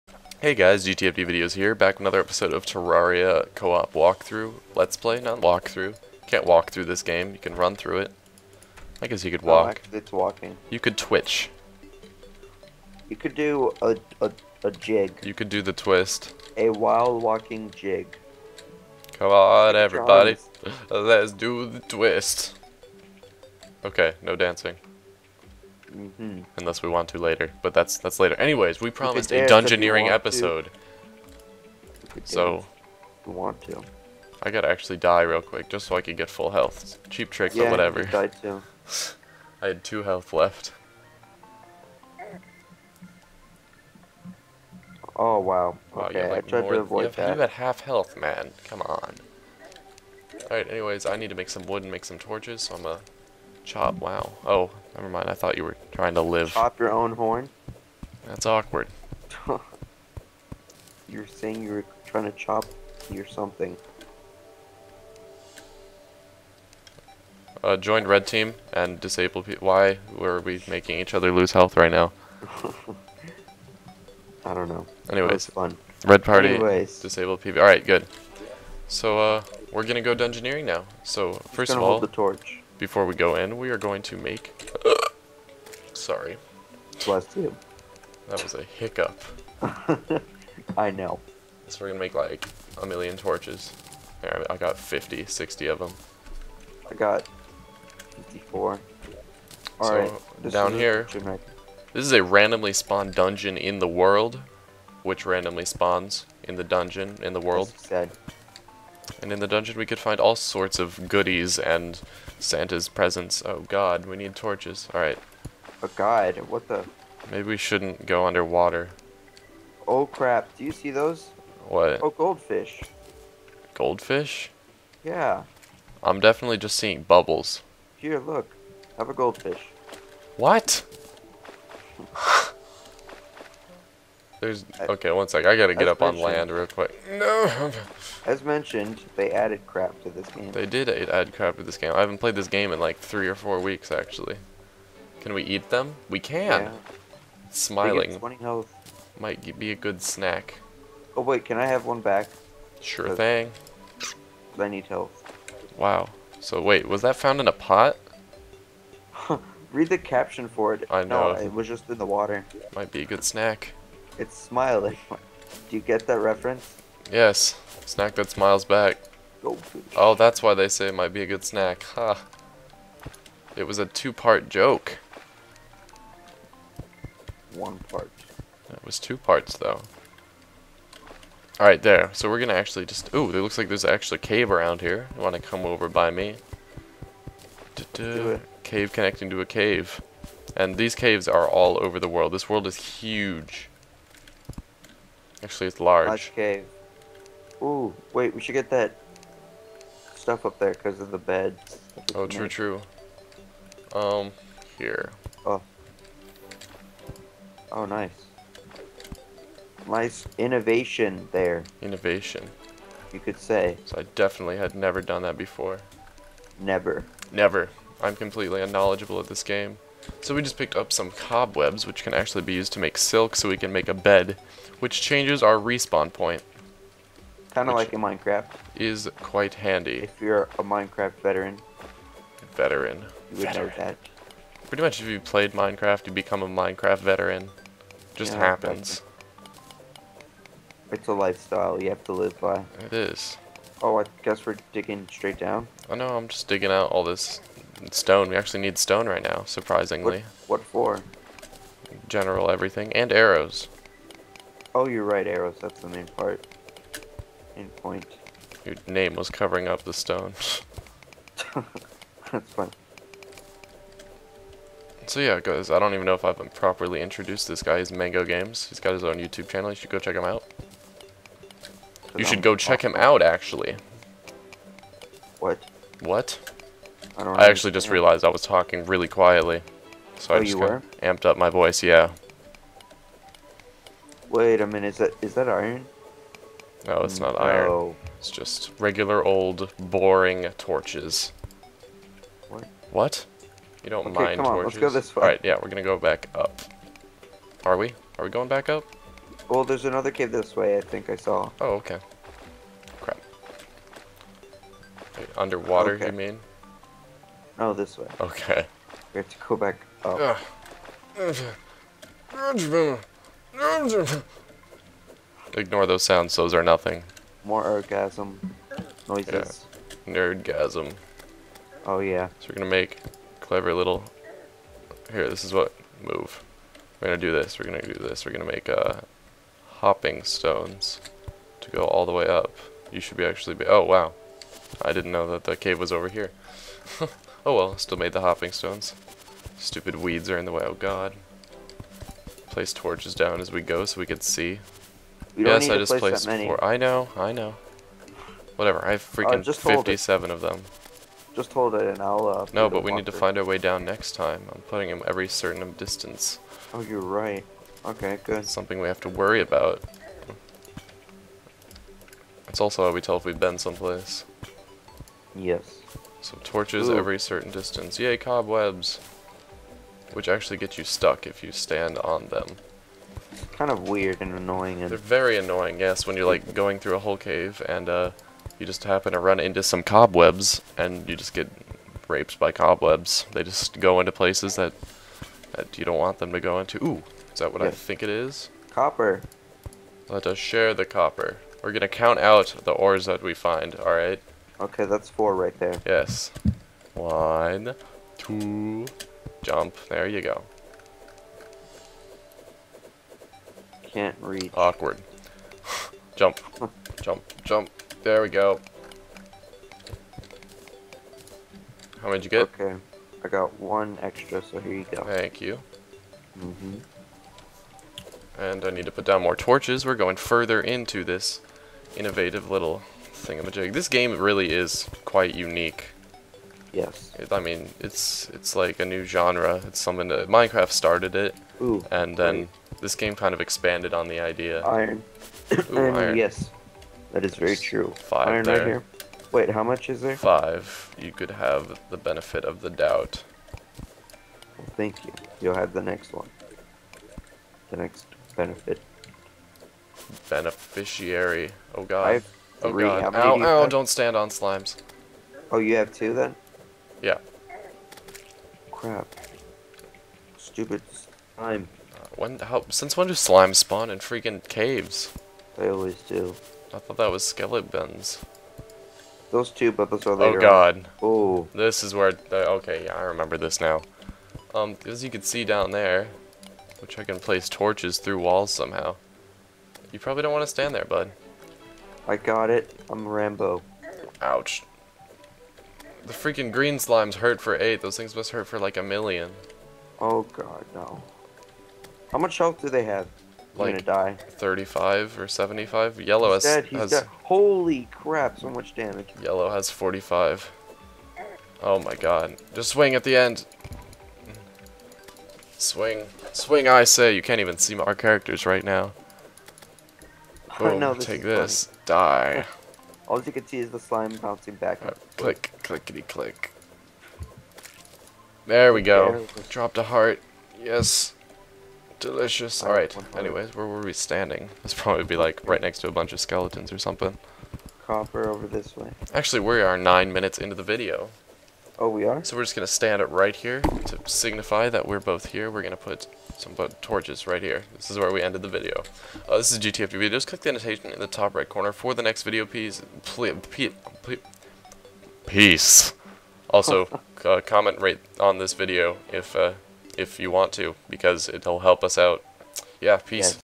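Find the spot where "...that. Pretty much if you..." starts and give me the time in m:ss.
3:53.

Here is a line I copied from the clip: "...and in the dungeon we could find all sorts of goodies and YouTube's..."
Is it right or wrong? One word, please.
wrong.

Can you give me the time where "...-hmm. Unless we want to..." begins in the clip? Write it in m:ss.
0:26.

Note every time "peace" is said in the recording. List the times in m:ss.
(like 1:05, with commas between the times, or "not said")
9:05, 9:12.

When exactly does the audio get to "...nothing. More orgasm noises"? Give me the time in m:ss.
5:16.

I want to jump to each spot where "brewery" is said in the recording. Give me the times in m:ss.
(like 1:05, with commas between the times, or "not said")
not said.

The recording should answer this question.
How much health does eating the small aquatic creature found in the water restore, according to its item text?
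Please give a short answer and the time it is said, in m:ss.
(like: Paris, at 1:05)
20, at 2:28.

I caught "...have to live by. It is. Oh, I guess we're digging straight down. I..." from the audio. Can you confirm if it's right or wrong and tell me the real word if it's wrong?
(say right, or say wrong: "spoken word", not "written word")
right.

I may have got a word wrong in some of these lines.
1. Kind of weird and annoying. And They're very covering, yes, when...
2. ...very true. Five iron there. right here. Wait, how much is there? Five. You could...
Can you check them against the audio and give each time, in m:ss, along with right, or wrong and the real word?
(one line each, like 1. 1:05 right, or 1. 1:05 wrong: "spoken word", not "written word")
1. 6:13 wrong: "annoying", not "covering"
2. 7:17 right.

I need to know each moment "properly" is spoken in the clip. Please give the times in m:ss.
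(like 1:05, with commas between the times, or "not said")
4:26.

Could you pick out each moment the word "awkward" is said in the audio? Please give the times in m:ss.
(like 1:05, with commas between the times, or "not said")
0:58, 6:44.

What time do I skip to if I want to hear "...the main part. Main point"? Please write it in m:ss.
4:15.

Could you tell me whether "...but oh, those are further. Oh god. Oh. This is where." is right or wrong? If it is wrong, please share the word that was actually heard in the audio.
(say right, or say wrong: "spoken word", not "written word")
wrong: "later", not "further".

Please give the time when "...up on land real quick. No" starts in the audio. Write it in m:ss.
2:15.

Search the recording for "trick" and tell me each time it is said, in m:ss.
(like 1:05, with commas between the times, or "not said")
0:37.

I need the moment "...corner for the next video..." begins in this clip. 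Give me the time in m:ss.
9:01.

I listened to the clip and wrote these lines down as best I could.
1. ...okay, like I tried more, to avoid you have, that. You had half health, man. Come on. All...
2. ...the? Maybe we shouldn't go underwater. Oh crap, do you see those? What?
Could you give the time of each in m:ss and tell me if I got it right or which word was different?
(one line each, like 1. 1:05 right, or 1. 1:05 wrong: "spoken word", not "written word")
1. 0:46 right
2. 1:56 right.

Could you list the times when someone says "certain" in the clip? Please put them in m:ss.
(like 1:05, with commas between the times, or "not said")
5:55, 6:07.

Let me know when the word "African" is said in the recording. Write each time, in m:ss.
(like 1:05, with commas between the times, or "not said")
not said.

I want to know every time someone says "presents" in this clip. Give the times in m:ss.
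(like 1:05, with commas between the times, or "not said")
1:52.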